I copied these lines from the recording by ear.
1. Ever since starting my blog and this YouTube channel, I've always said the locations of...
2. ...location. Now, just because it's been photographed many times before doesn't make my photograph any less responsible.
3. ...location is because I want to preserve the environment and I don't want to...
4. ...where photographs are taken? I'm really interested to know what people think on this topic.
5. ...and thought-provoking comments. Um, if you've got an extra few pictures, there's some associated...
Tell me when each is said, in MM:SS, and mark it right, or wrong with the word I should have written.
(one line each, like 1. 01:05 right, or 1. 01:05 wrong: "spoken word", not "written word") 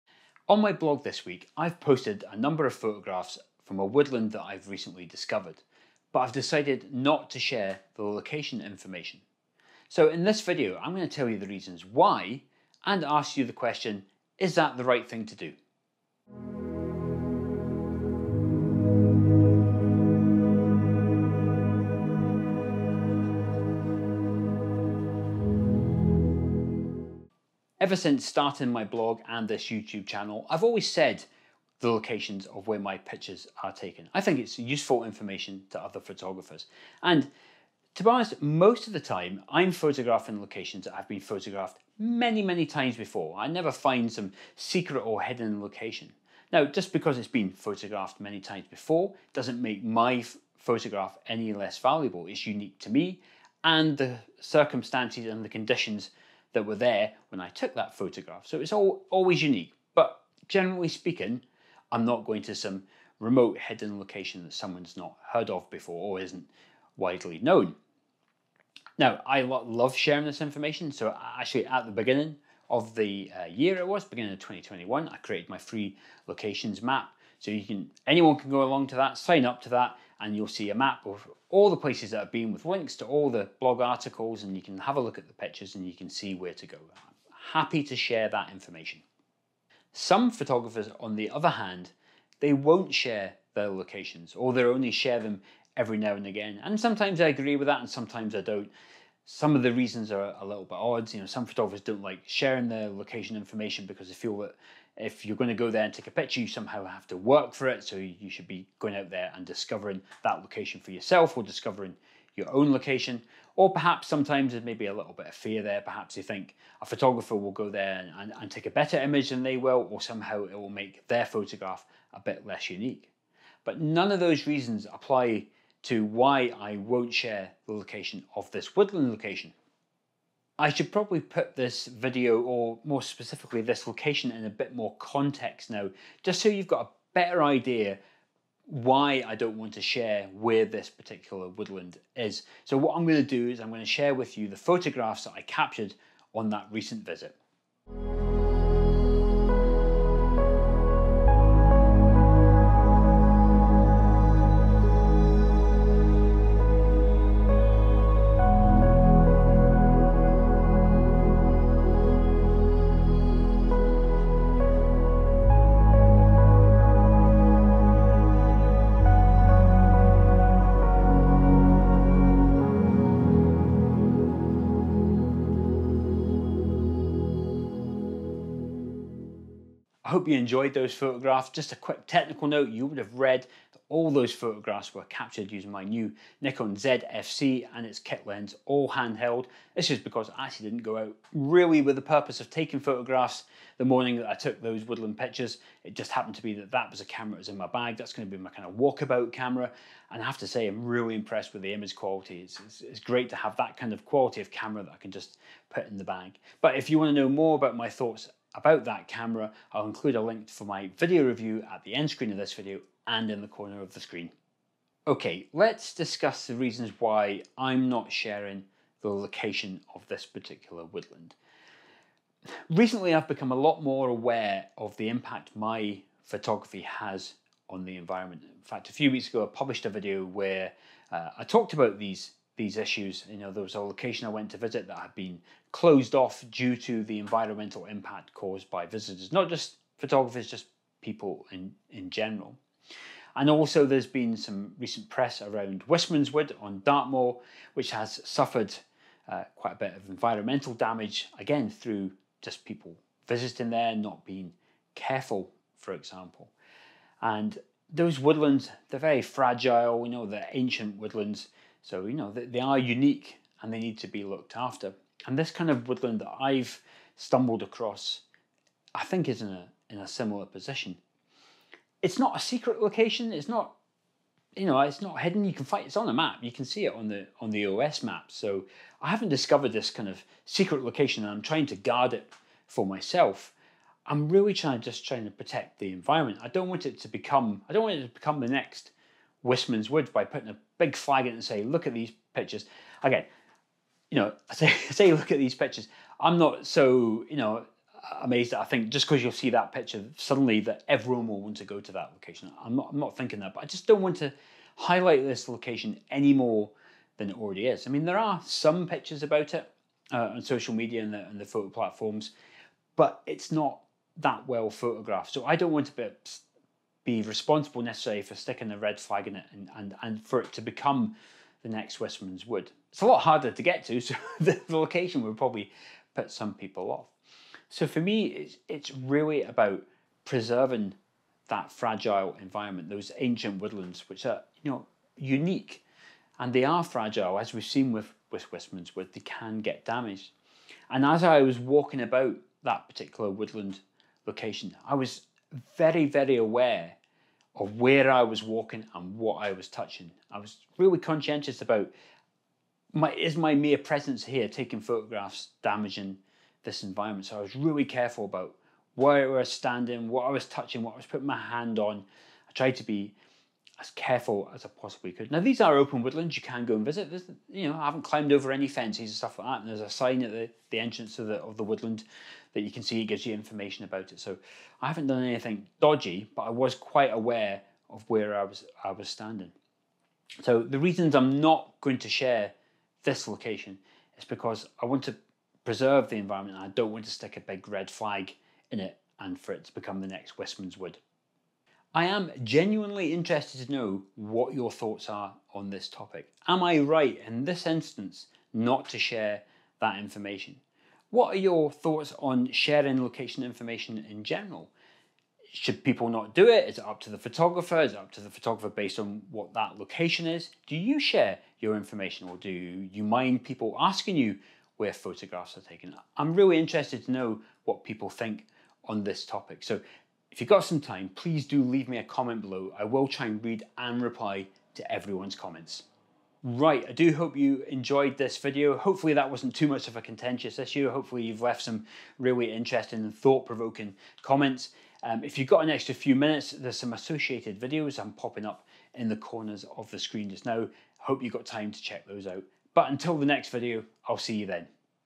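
1. 00:27 right
2. 00:45 wrong: "valuable", not "responsible"
3. 06:23 right
4. 06:54 right
5. 07:13 wrong: "minutes", not "pictures".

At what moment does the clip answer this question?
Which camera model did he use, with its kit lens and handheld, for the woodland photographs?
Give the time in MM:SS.
03:06.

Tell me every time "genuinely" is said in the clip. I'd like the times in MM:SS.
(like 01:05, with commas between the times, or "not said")
06:32.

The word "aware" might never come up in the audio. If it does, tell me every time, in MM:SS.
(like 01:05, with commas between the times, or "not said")
03:44, 05:46, 06:17.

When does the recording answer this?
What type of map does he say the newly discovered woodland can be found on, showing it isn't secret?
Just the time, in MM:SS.
04:37.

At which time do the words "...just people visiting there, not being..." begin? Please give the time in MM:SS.
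04:12.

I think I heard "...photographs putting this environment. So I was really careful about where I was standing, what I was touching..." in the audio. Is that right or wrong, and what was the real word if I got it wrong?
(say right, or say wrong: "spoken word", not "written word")
wrong: "damaging", not "putting".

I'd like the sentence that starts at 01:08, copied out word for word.
Now, I love sharing this information.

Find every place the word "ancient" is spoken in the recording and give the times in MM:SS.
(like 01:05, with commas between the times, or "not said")
04:20, 05:33.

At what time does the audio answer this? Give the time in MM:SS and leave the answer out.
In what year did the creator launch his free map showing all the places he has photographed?
01:14.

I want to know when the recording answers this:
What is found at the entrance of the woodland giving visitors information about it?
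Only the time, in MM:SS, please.
06:09.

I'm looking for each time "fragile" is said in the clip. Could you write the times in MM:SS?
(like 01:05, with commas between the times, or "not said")
04:19, 05:31, 05:36.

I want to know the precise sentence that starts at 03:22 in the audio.
It's, it's, it's great to have that kind of quality of camera that I can just put in the bag.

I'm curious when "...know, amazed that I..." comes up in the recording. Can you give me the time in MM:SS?
04:57.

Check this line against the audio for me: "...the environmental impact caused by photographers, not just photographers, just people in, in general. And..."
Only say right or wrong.
wrong.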